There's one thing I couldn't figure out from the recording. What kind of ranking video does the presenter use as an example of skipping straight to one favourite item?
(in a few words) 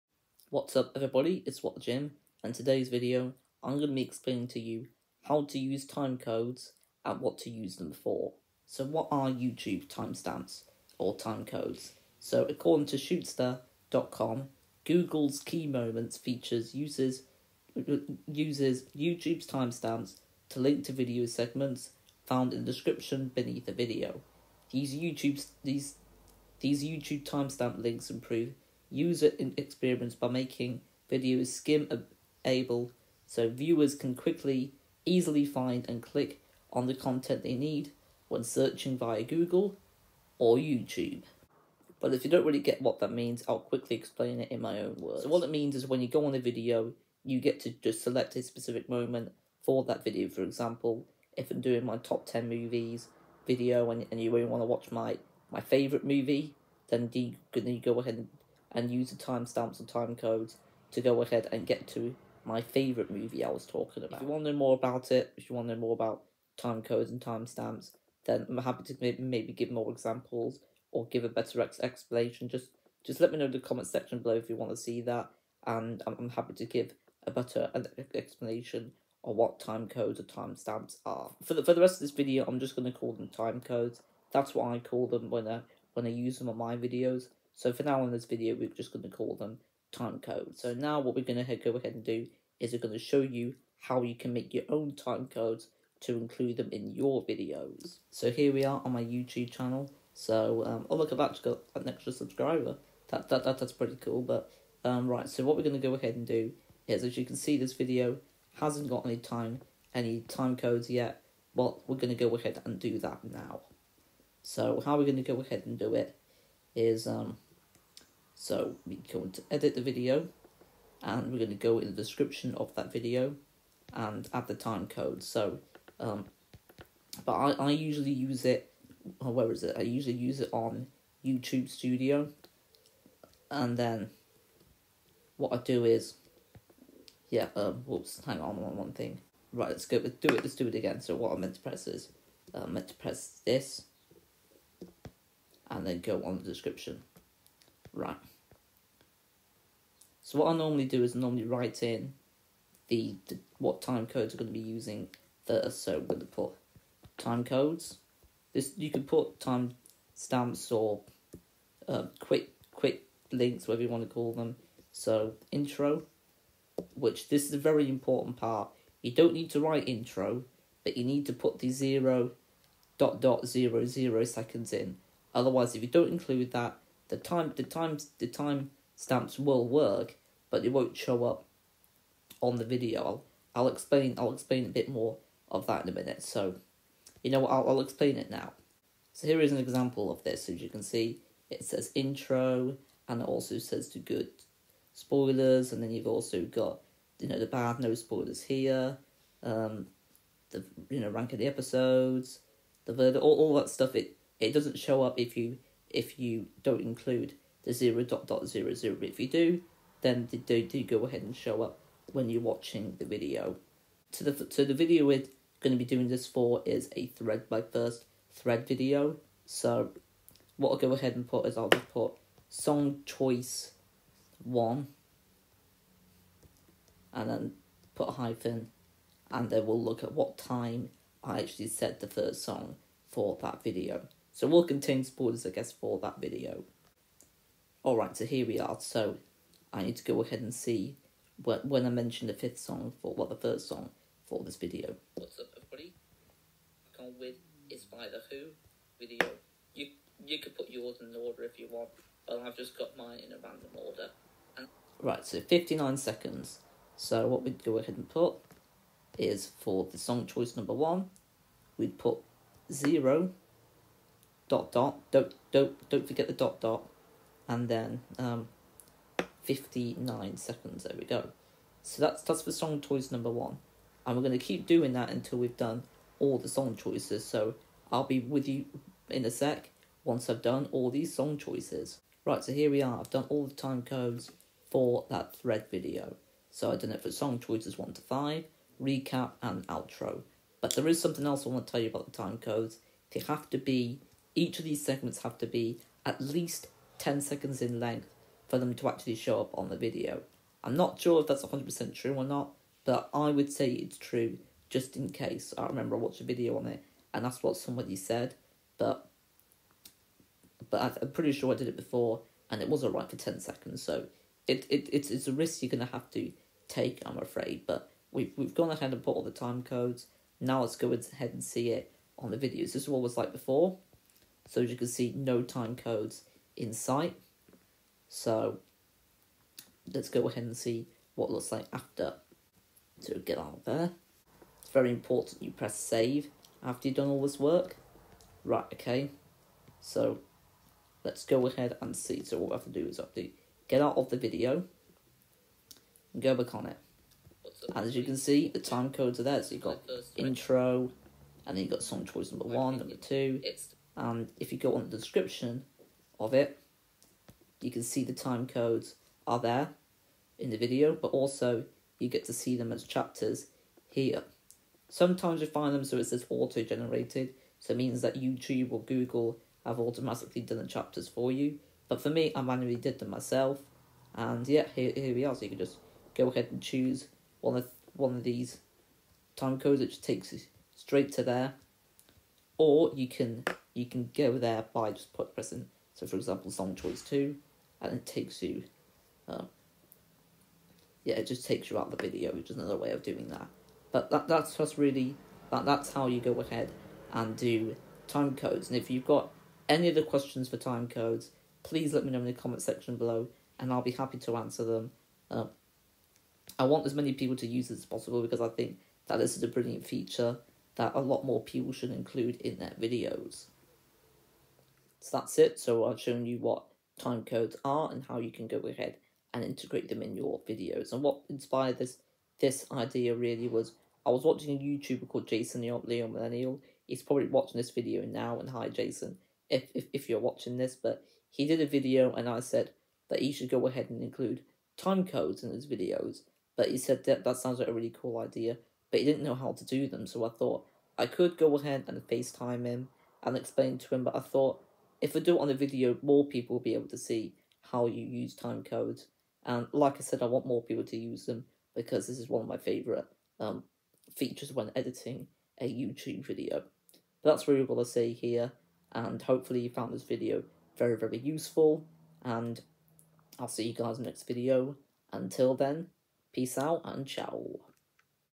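Top 10 movies.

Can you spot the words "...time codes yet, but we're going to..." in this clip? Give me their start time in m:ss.
1:50.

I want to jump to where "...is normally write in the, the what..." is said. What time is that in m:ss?
2:31.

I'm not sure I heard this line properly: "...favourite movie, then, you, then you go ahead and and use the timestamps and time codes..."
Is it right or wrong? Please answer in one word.
right.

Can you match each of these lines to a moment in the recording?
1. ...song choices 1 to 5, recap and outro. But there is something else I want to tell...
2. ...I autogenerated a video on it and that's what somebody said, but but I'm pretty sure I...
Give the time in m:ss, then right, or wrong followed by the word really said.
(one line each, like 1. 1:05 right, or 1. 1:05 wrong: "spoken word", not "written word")
1. 4:47 right
2. 5:05 wrong: "watched", not "autogenerated".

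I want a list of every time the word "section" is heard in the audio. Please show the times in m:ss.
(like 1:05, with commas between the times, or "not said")
1:13, 6:42.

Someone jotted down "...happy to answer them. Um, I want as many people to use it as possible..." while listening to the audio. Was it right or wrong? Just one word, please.
right.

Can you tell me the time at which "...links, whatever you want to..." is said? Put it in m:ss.
2:43.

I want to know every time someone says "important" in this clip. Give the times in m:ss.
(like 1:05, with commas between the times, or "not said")
2:47, 5:34.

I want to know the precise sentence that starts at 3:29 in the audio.
If you do, then they do, go ahead and show up when you're watching the video.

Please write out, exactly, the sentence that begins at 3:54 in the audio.
So we'll contain spoilers I guess for that video.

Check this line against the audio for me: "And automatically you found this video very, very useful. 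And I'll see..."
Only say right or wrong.
wrong.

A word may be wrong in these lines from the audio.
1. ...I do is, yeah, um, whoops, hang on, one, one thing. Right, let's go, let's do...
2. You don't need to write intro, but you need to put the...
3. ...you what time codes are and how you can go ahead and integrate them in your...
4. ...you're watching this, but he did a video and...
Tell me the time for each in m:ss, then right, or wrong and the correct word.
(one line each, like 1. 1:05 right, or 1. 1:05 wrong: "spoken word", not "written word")
1. 2:15 right
2. 2:49 right
3. 6:56 right
4. 7:10 right.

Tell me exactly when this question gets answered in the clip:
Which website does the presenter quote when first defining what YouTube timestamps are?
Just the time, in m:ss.
0:12.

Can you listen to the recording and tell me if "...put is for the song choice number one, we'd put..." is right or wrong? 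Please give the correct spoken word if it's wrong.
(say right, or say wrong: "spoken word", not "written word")
right.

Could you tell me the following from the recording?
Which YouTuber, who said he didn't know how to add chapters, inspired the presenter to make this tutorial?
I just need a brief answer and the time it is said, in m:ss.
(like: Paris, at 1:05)
Jason Leo Millennial, at 7:05.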